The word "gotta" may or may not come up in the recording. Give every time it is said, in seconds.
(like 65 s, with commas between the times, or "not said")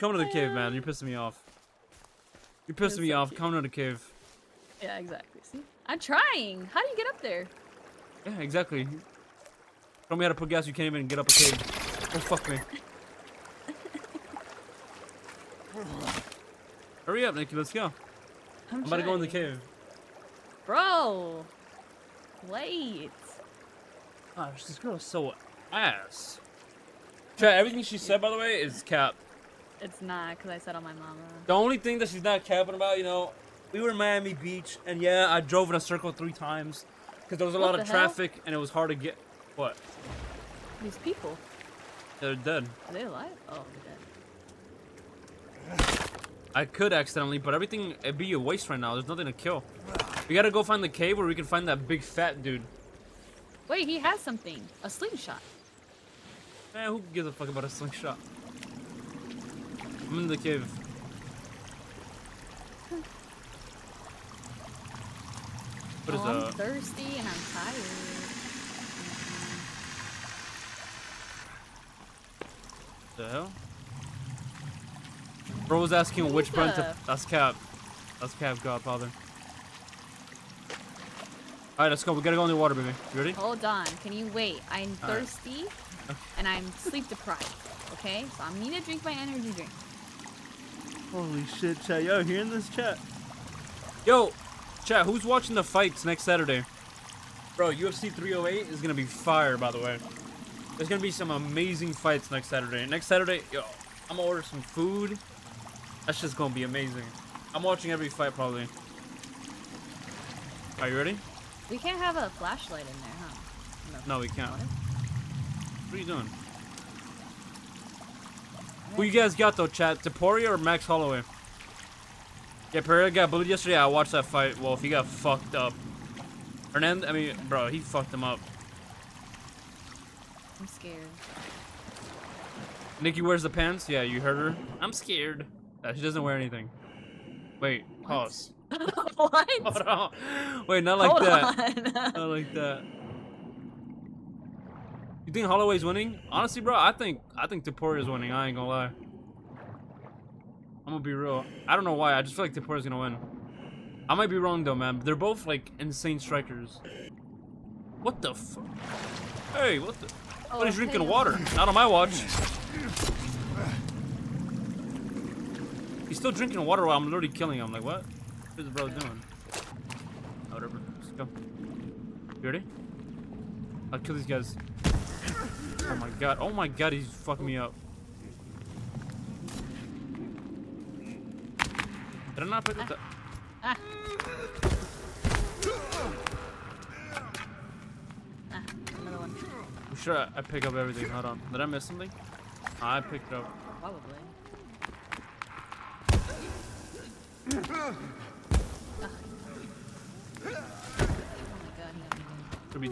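50 s, 82 s.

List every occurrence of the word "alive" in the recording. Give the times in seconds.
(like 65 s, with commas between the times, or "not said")
43 s.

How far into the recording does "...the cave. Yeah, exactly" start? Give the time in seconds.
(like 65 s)
3 s.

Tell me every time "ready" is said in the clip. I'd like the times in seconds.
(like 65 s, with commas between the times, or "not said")
83 s, 110 s, 172 s.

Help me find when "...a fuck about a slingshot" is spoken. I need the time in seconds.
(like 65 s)
57 s.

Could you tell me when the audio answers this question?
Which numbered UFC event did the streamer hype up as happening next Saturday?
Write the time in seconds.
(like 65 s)
97 s.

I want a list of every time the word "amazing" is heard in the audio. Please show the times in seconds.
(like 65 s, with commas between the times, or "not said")
101 s, 106 s.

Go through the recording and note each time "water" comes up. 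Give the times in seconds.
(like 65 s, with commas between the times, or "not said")
82 s, 161 s, 166 s.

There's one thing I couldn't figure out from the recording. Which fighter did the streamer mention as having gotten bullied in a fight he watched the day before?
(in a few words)
Pereira.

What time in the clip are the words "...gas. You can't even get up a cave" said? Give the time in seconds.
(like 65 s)
10 s.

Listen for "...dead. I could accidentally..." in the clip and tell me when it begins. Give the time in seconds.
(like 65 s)
43 s.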